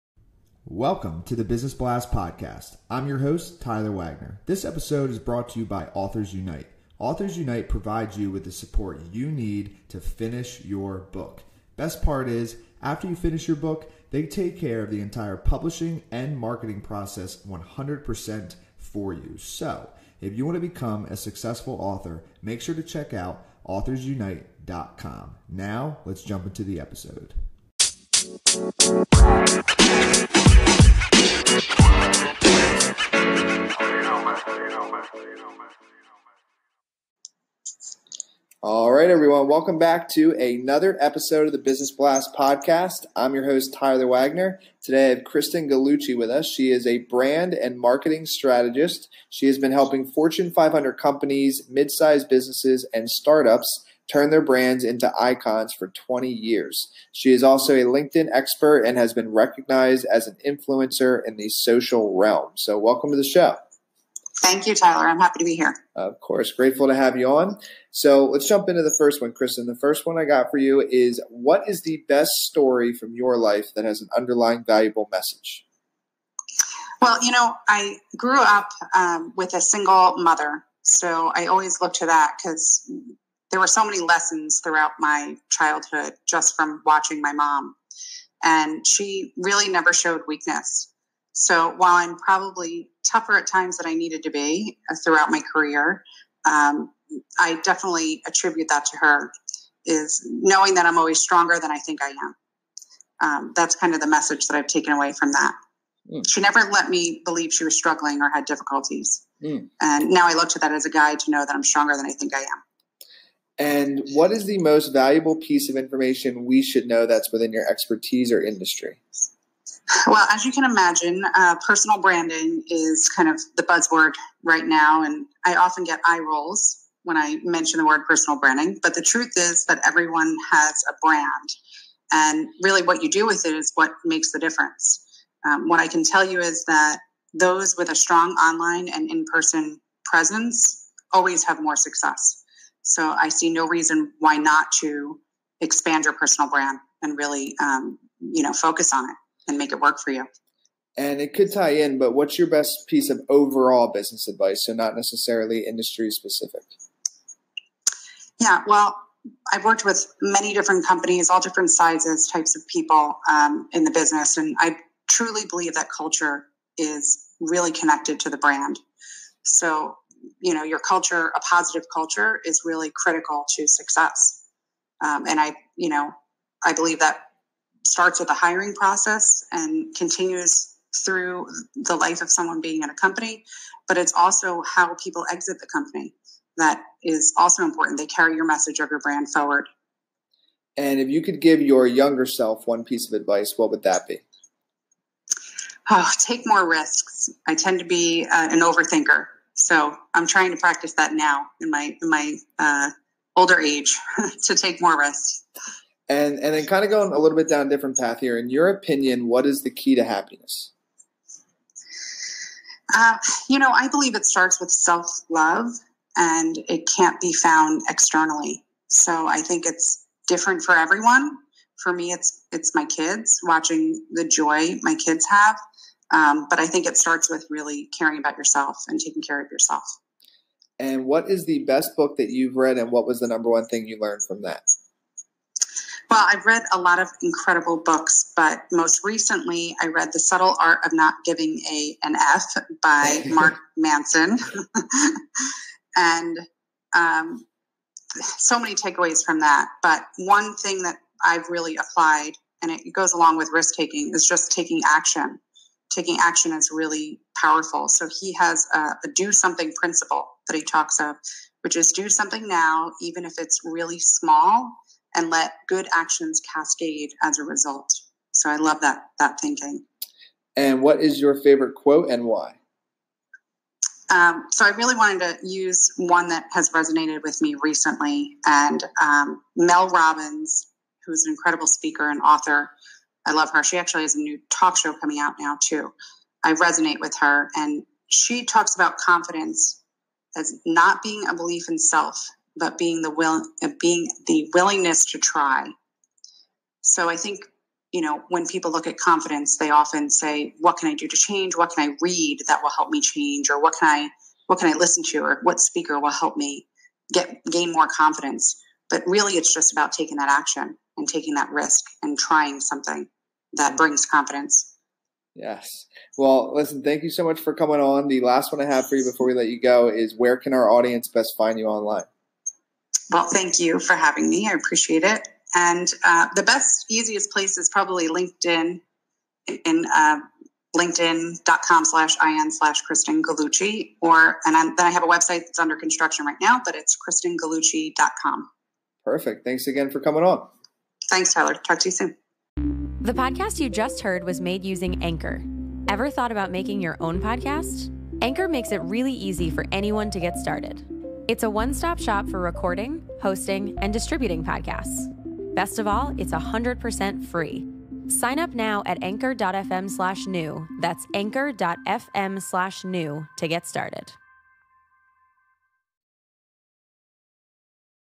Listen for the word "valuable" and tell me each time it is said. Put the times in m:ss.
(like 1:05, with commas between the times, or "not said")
1:14, 1:54.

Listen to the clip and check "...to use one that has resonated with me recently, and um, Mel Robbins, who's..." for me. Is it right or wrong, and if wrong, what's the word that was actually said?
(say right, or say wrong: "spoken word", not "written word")
right.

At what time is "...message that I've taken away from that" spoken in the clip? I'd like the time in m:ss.
1:44.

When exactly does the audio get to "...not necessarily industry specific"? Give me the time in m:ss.
2:34.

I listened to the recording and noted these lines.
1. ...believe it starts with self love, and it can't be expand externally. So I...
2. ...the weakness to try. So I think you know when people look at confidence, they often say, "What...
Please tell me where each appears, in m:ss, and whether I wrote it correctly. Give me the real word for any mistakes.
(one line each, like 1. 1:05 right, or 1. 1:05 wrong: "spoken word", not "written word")
1. 3:33 wrong: "found", not "expand"
2. 4:54 wrong: "willingness", not "weakness".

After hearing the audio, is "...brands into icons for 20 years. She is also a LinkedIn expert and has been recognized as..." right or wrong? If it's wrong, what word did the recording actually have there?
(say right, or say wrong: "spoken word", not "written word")
right.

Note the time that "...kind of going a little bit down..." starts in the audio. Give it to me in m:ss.
3:26.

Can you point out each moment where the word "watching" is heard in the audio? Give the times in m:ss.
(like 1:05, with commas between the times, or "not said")
1:26, 3:43.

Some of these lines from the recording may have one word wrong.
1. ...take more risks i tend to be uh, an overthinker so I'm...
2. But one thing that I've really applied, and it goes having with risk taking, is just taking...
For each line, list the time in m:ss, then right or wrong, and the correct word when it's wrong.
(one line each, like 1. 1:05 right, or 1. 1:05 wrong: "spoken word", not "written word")
1. 3:16 right
2. 4:09 wrong: "along", not "having".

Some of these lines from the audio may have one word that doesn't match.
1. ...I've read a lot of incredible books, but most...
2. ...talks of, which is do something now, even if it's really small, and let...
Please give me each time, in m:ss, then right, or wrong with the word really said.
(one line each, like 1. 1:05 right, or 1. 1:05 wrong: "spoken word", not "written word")
1. 3:56 right
2. 4:20 right.